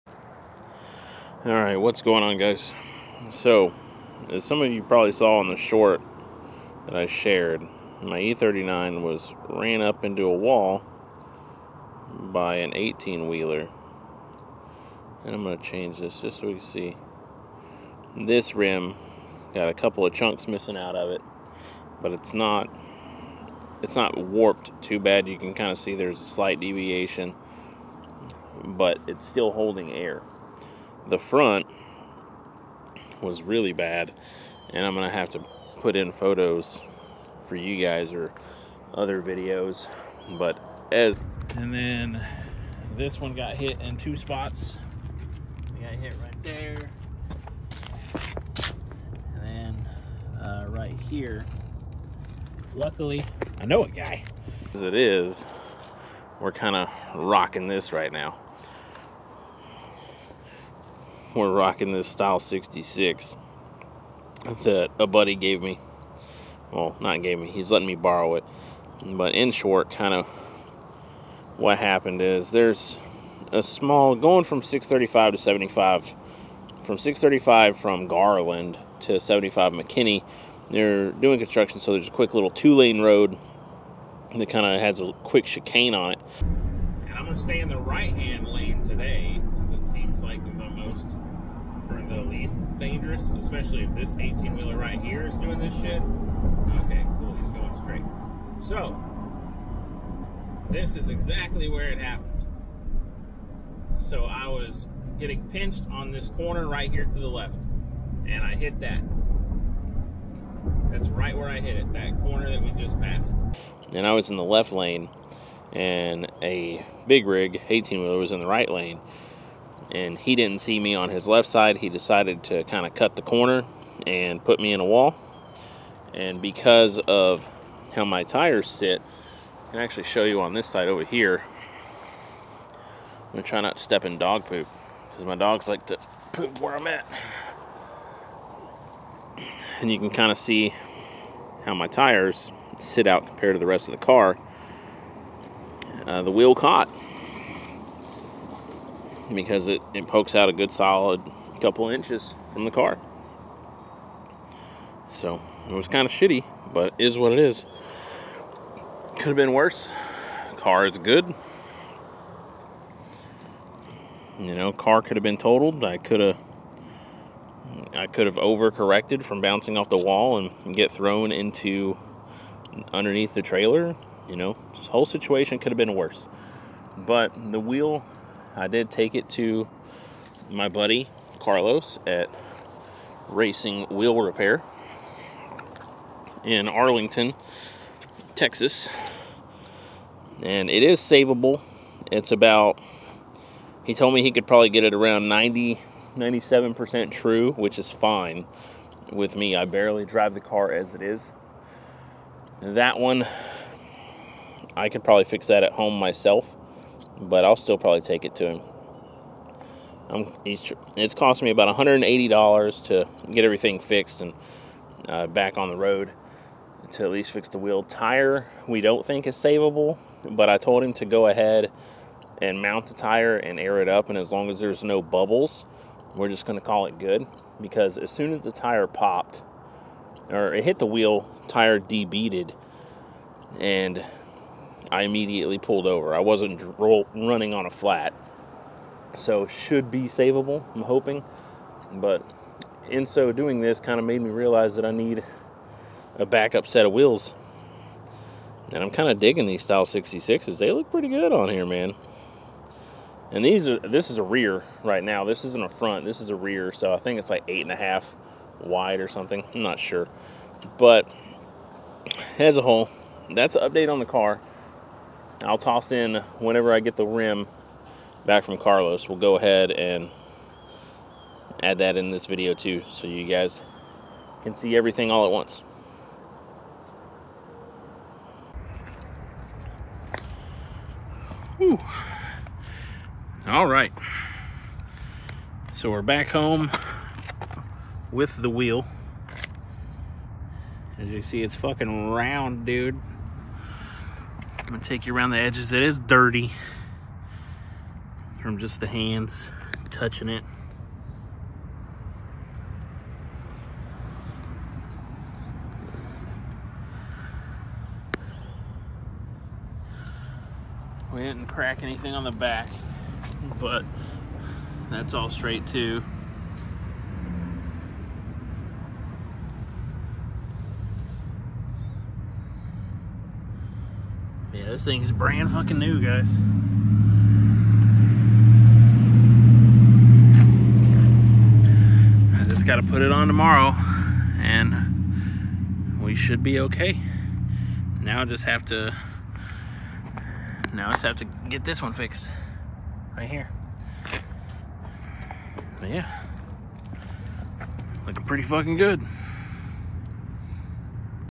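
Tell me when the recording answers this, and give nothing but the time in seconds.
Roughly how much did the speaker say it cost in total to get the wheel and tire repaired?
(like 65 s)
211 s.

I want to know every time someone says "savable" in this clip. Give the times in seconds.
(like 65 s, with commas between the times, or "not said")
190 s, 219 s, 240 s.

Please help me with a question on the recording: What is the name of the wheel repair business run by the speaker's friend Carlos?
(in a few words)
Racing Wheel Repair.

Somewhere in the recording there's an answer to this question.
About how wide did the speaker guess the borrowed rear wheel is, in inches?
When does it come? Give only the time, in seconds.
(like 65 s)
257 s.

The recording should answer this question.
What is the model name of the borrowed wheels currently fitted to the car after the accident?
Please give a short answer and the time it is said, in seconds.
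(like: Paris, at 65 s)
Style 66, at 62 s.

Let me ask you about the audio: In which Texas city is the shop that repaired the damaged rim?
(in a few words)
Arlington.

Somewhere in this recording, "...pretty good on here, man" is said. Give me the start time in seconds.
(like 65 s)
250 s.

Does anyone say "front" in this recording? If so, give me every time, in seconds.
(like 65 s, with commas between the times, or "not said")
31 s, 255 s.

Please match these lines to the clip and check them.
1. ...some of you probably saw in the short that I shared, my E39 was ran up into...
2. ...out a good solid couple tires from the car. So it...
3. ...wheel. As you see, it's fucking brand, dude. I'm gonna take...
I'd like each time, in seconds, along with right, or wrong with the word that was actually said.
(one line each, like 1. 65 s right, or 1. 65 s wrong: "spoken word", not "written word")
1. 4 s right
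2. 150 s wrong: "inches", not "tires"
3. 288 s wrong: "round", not "brand".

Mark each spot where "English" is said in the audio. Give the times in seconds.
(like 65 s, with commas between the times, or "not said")
not said.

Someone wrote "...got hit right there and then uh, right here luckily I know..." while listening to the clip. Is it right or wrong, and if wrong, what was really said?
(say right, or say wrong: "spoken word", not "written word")
right.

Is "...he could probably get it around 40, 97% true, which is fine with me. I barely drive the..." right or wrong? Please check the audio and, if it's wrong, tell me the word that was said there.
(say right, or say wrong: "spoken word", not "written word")
wrong: "90", not "40".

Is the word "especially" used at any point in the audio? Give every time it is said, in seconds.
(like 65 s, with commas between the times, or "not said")
93 s.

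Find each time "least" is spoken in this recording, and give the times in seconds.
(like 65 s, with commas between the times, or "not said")
92 s, 217 s.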